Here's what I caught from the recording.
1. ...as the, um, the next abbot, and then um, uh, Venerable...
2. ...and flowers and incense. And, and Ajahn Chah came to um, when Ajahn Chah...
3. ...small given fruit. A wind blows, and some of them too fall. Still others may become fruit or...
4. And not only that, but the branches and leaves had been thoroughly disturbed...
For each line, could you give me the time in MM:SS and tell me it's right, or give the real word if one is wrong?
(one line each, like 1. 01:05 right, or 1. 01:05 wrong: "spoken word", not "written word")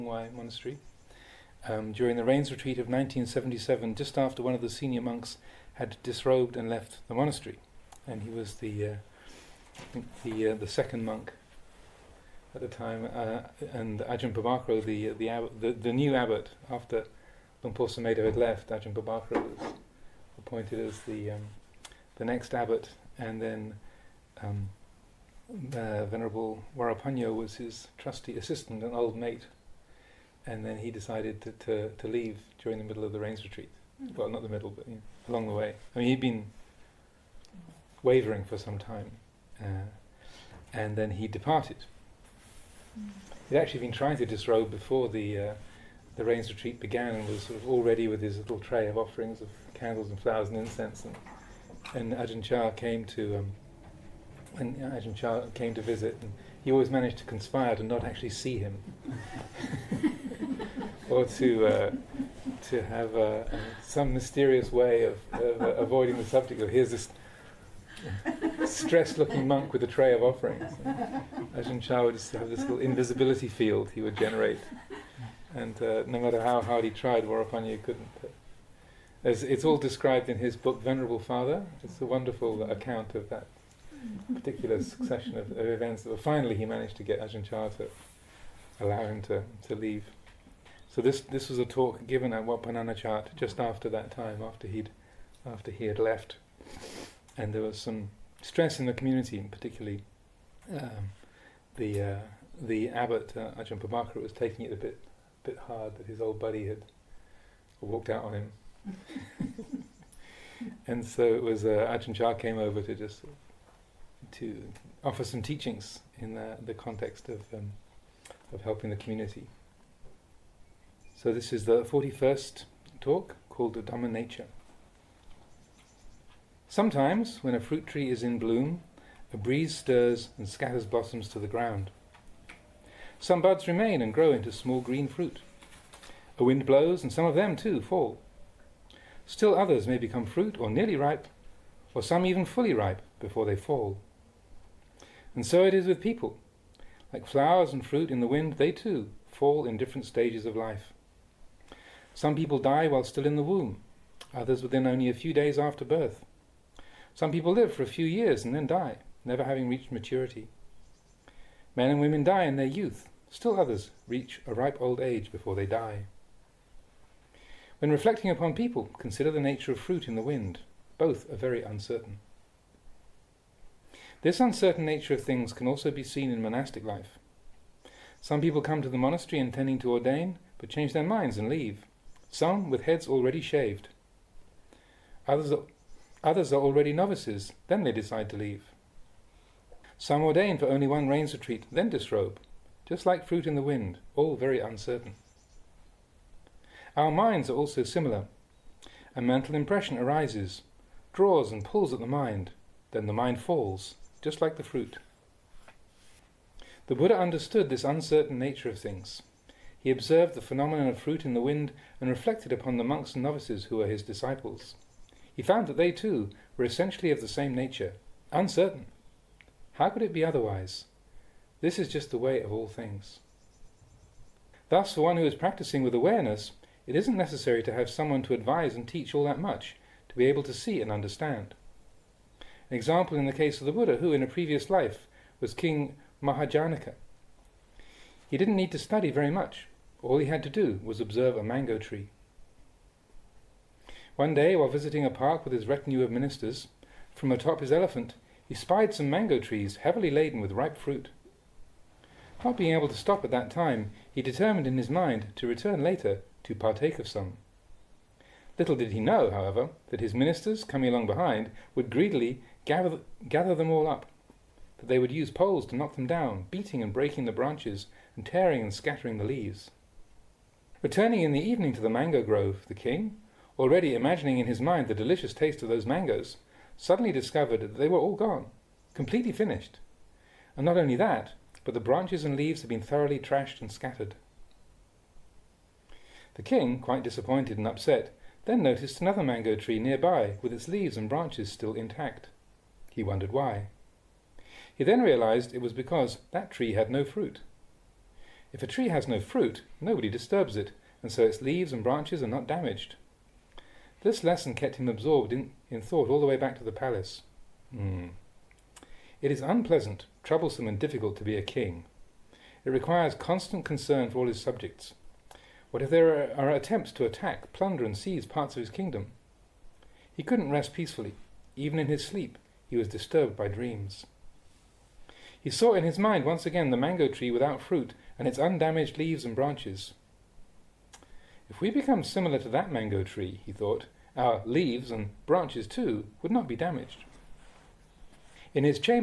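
1. 00:20 right
2. 00:50 right
3. 02:14 wrong: "green", not "given"
4. 04:40 wrong: "trashed", not "disturbed".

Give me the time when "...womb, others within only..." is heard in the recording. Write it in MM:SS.
02:33.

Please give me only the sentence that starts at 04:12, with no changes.
Not being able to stop at that time, he determined in his mind to return later to partake of some.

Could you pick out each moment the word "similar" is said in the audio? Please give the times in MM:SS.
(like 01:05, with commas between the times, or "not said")
03:17, 05:32.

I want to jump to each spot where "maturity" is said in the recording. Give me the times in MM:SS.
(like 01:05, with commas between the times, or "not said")
02:39.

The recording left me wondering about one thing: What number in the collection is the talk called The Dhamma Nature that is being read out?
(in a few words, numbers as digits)
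41st.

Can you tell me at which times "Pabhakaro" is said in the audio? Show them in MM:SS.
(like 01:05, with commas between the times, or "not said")
00:14, 00:18, 01:43.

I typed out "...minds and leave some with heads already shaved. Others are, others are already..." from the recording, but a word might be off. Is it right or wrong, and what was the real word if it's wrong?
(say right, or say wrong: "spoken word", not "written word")
right.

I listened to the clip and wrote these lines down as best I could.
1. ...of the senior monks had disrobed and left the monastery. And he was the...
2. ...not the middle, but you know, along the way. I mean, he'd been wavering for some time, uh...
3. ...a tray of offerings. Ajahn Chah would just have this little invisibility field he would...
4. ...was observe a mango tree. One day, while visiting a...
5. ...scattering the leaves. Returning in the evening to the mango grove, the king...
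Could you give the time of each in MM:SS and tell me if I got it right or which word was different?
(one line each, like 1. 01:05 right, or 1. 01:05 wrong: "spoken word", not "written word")
1. 00:04 right
2. 00:34 right
3. 01:09 right
4. 04:00 right
5. 04:28 right.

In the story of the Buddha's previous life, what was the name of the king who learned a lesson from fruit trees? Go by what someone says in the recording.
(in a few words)
King Mahajanaka.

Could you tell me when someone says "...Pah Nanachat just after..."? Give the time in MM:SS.
01:32.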